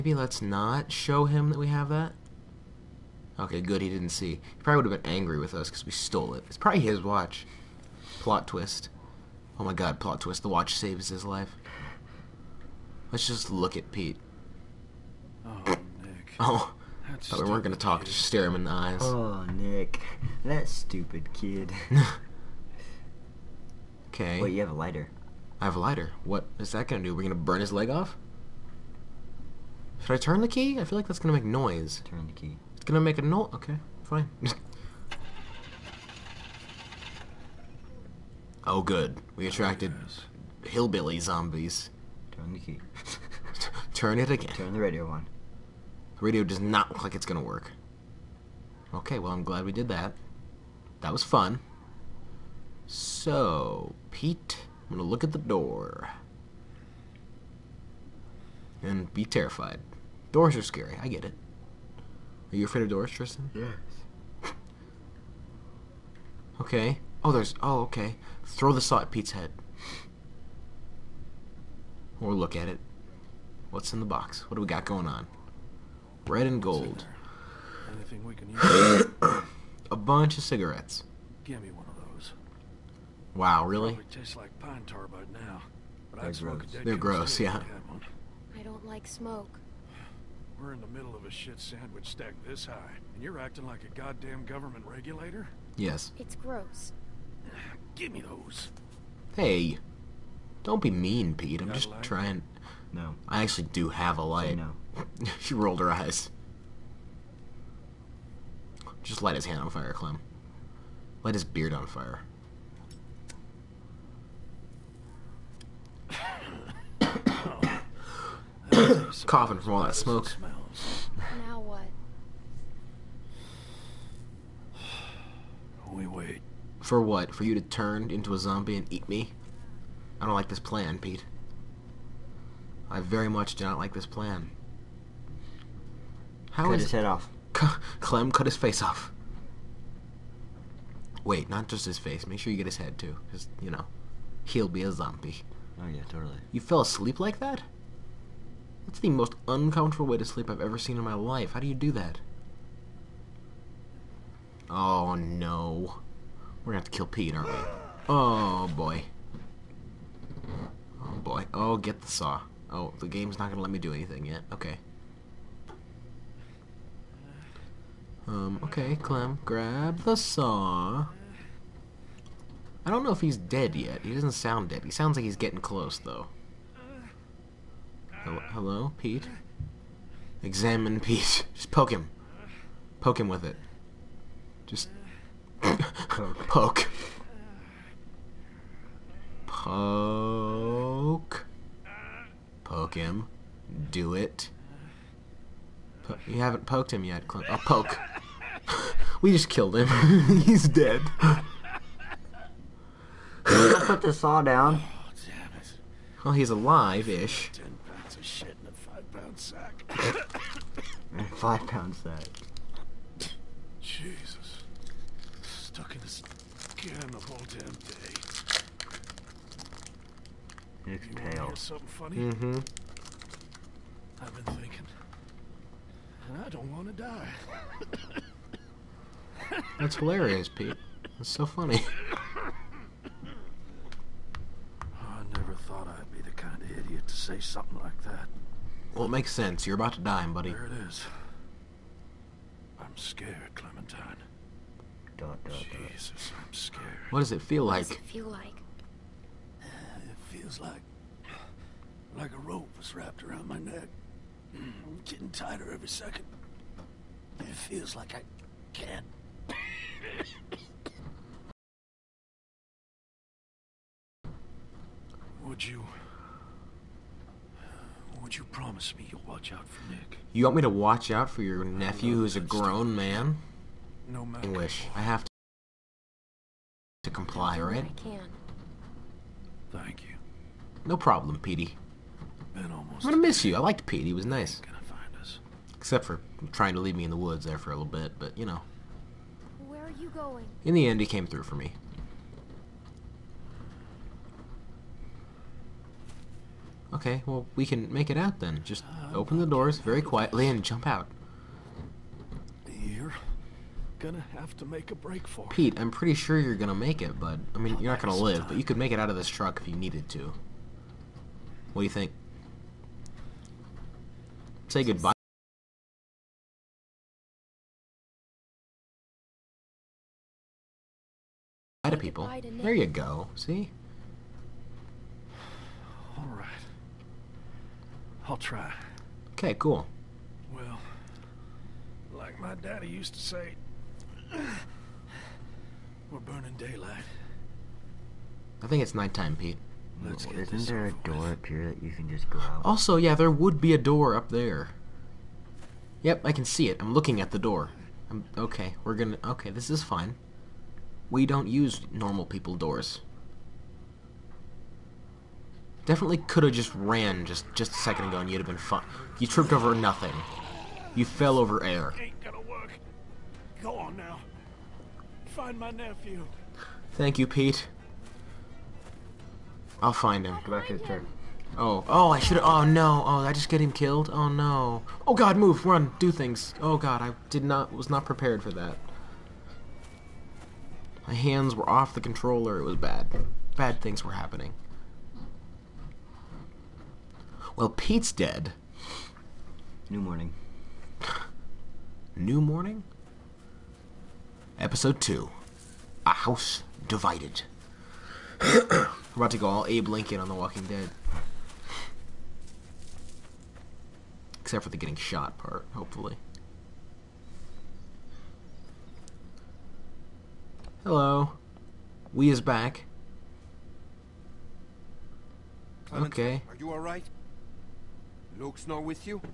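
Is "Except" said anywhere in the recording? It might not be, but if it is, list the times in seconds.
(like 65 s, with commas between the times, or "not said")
285 s, 404 s.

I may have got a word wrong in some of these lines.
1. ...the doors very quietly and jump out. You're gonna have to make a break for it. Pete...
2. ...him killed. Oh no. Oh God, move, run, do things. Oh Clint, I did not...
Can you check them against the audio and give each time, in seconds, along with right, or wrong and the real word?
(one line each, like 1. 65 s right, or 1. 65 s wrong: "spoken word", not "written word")
1. 299 s right
2. 373 s wrong: "God", not "Clint".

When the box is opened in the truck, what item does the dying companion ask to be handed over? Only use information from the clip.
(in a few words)
Cigarettes.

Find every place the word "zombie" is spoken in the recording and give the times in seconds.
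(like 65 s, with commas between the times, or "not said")
41 s, 128 s, 144 s.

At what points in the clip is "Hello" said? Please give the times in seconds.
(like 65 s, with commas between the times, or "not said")
178 s, 410 s.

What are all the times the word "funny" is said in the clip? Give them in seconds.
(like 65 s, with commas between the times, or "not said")
221 s, 231 s.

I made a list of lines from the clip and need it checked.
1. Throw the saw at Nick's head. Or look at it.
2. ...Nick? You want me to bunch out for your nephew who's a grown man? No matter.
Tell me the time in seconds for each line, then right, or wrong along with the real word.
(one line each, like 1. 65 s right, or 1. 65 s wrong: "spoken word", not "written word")
1. 68 s wrong: "Pete", not "Nick"
2. 269 s wrong: "watch", not "bunch".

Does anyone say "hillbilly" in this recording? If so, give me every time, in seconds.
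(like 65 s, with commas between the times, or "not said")
40 s.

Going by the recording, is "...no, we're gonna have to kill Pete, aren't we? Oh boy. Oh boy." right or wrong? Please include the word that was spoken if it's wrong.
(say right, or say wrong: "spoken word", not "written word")
right.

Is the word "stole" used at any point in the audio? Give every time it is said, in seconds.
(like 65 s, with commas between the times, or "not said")
5 s.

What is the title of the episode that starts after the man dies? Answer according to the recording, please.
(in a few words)
A House Divided.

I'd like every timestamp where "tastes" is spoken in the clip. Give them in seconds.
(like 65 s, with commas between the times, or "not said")
84 s.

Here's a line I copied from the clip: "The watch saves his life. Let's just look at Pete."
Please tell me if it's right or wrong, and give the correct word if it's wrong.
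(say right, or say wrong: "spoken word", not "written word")
right.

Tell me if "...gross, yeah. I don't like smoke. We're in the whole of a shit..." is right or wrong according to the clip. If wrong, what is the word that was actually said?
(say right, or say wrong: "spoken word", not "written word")
wrong: "middle", not "whole".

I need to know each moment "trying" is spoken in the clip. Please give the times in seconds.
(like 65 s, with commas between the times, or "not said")
102 s, 286 s.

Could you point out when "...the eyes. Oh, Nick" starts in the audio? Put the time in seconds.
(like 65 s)
18 s.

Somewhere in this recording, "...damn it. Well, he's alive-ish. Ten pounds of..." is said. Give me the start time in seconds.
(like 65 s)
205 s.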